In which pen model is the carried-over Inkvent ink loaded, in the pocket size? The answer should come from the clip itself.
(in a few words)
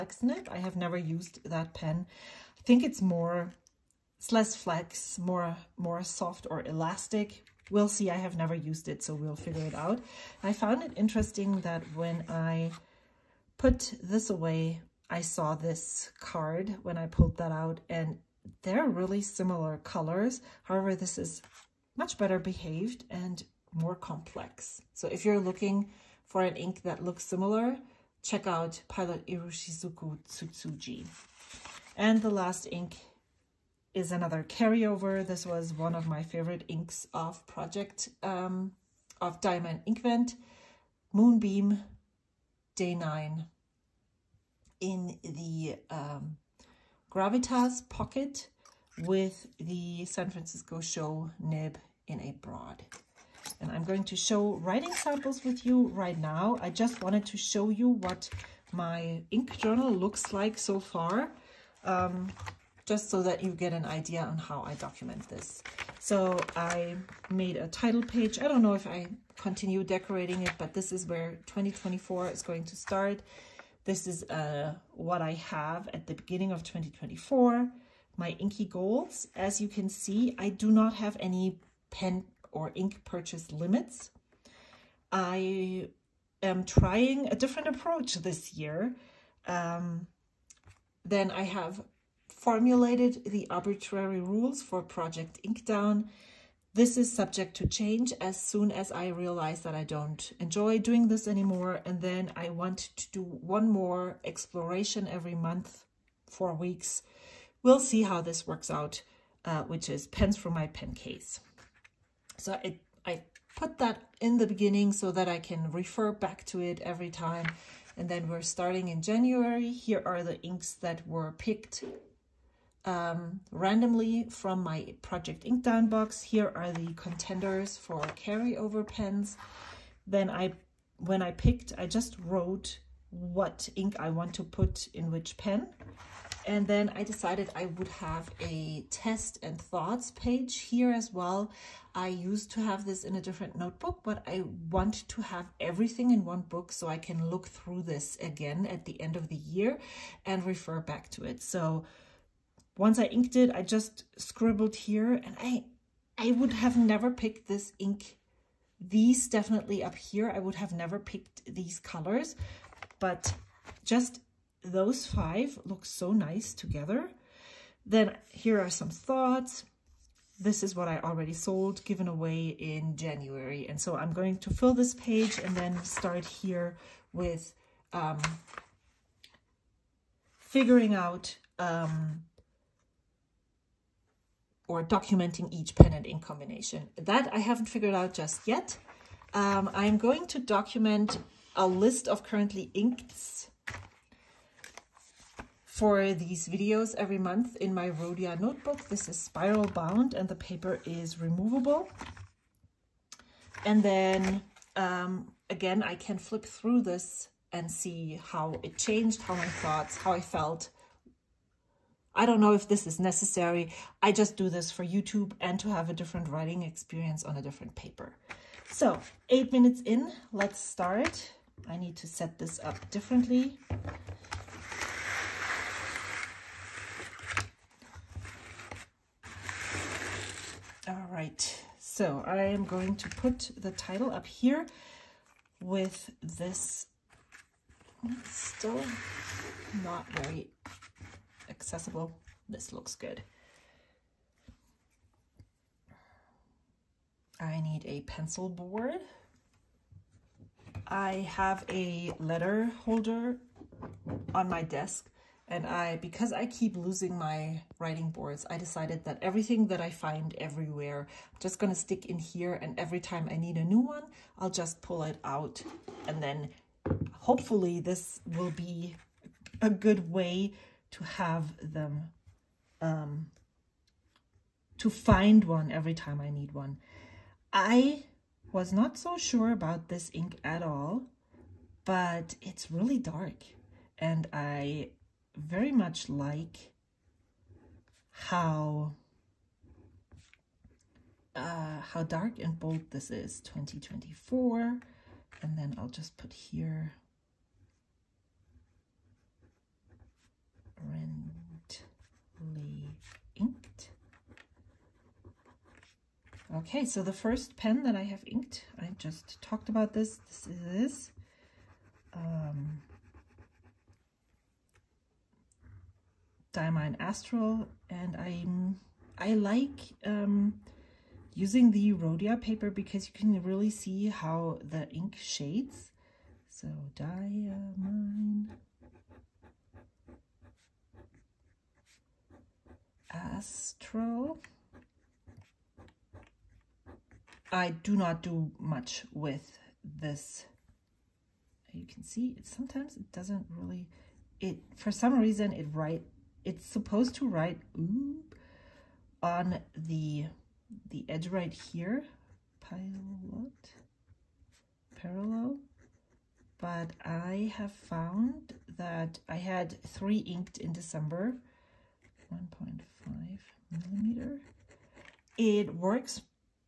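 Gravitas.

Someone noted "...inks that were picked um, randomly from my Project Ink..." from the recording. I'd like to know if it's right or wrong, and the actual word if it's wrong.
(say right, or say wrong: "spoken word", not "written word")
right.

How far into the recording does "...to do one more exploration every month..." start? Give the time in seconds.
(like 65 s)
102 s.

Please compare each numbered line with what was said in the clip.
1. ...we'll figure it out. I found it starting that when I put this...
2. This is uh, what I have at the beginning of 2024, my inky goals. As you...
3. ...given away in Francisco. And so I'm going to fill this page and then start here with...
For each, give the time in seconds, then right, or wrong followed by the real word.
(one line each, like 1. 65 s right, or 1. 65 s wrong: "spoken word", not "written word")
1. 9 s wrong: "interesting", not "starting"
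2. 73 s right
3. 171 s wrong: "January", not "Francisco".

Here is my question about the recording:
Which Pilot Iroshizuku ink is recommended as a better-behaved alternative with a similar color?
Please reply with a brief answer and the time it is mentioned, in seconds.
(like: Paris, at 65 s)
Tsutsuji, at 30 s.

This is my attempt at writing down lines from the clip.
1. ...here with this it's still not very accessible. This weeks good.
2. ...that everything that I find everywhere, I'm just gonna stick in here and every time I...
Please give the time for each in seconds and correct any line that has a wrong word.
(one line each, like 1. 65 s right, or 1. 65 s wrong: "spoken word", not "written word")
1. 234 s wrong: "looks", not "weeks"
2. 259 s right.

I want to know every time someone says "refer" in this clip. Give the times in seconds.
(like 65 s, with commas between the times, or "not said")
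115 s, 150 s.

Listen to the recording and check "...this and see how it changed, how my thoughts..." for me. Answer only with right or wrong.
right.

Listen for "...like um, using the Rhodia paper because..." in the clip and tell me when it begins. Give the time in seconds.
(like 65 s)
319 s.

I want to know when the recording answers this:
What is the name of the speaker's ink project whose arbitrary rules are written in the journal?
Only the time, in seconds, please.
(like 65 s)
94 s.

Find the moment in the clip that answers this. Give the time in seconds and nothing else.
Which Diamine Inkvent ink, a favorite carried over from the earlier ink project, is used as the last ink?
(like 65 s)
41 s.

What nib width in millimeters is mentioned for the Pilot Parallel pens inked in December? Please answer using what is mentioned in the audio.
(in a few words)
1.5 millimeter.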